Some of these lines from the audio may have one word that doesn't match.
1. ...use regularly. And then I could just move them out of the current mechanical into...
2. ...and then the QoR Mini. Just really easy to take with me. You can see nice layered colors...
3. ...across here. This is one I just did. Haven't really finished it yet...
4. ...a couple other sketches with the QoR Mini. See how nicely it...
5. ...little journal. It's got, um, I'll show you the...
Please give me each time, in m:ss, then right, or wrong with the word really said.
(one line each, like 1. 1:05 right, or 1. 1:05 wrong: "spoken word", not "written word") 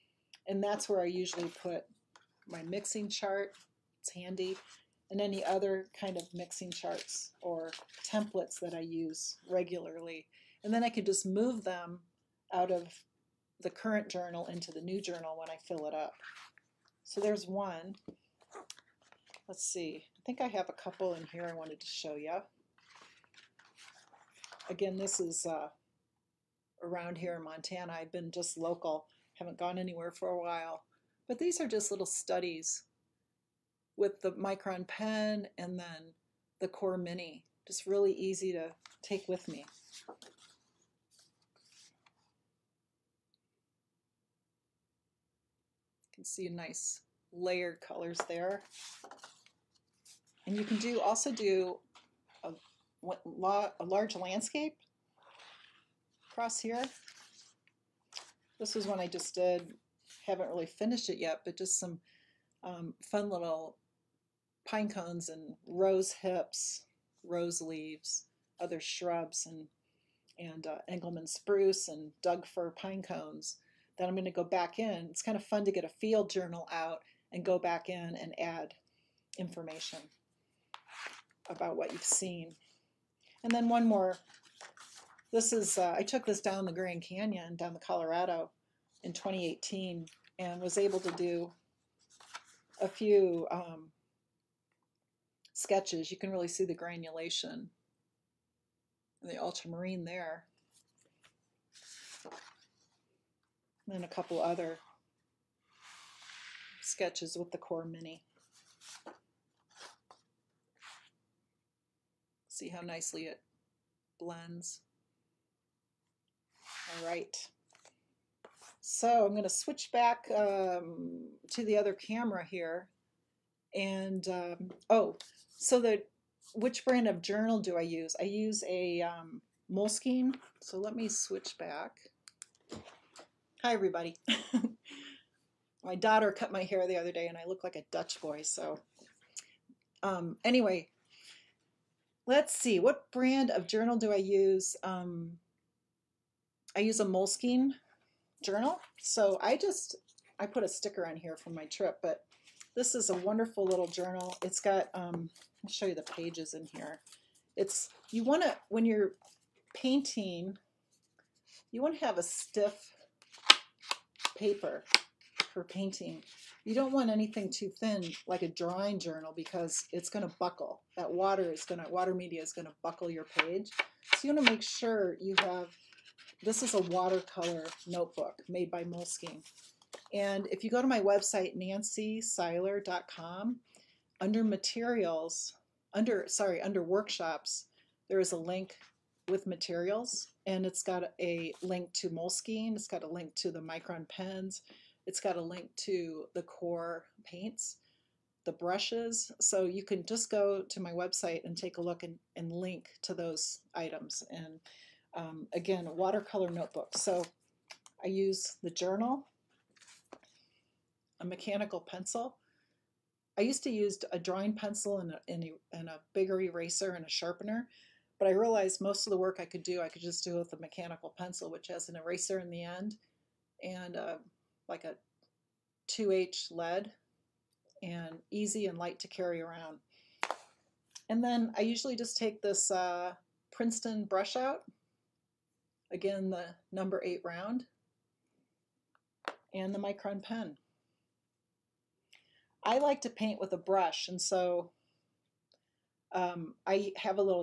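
1. 0:08 wrong: "journal", not "mechanical"
2. 0:35 right
3. 0:56 right
4. 1:44 right
5. 2:33 right.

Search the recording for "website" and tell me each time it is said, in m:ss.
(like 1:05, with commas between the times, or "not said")
3:01, 3:20.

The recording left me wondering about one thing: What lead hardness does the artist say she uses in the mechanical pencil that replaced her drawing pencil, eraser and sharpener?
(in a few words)
2H.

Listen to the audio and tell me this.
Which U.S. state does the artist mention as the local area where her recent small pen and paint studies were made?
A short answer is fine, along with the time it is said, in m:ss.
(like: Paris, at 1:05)
Montana, at 0:27.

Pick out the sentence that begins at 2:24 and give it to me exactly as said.
Um, I use a Moleskine journal.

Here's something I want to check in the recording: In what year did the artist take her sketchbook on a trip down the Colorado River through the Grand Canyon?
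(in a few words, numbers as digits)
2018.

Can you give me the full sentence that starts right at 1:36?
You can really see the granulation and the ultramarine there.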